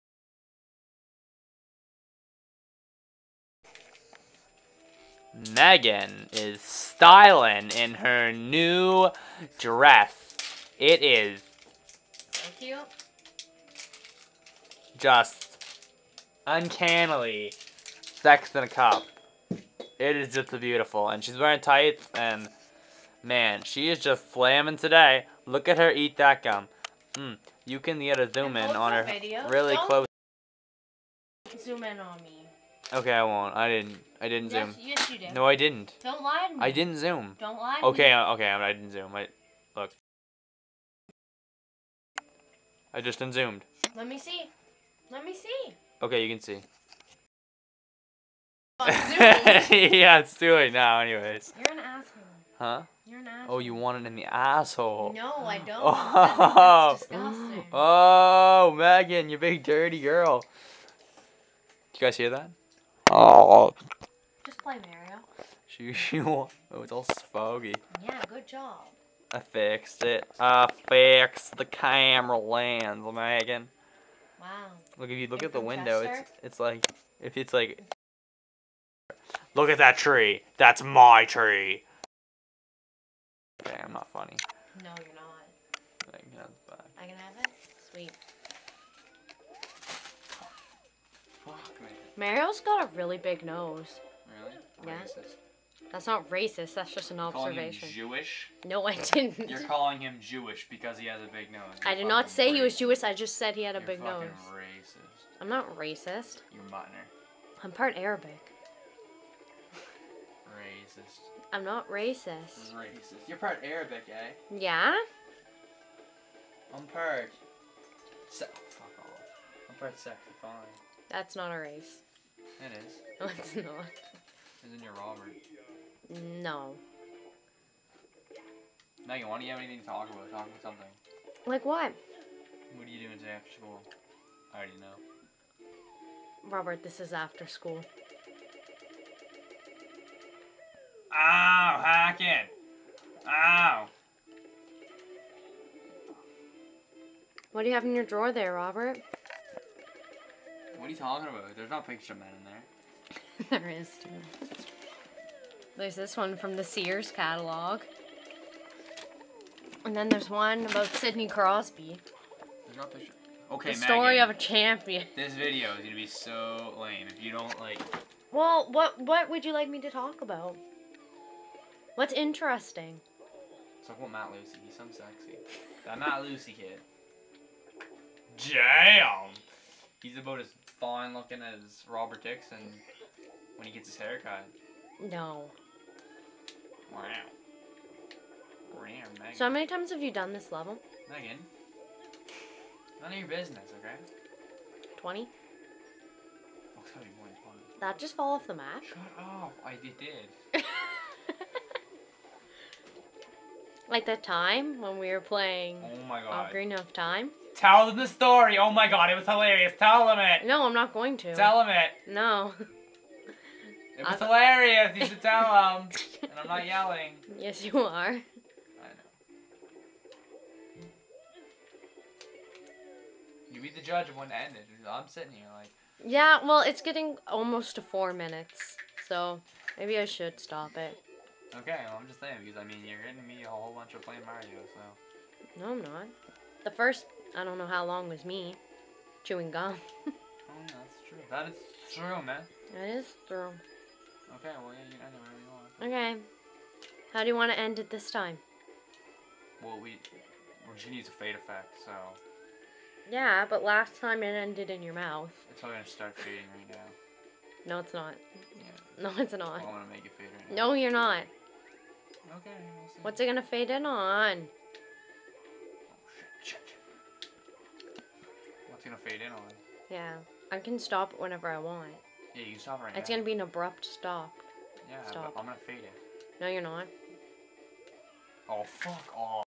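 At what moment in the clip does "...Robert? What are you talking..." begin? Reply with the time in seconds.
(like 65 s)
148 s.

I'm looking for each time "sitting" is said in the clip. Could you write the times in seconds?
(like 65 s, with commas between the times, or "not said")
225 s.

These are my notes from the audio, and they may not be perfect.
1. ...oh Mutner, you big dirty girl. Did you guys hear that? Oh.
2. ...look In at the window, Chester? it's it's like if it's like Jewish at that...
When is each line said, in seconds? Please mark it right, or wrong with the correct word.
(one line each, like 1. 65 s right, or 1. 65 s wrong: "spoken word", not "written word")
1. 57 s wrong: "Megan", not "Mutner"
2. 75 s wrong: "Look", not "Jewish".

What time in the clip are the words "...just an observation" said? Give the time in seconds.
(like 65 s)
96 s.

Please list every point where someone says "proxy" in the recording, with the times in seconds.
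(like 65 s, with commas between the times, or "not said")
not said.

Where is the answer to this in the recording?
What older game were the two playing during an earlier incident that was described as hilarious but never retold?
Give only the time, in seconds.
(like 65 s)
206 s.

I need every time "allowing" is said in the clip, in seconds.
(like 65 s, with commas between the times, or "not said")
not said.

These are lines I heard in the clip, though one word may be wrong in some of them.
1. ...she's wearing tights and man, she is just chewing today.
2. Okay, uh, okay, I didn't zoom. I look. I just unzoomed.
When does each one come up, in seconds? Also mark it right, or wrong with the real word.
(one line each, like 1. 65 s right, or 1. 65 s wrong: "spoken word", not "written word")
1. 21 s wrong: "flaming", not "chewing"
2. 38 s right.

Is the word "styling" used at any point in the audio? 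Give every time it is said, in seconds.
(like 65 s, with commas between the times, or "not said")
6 s.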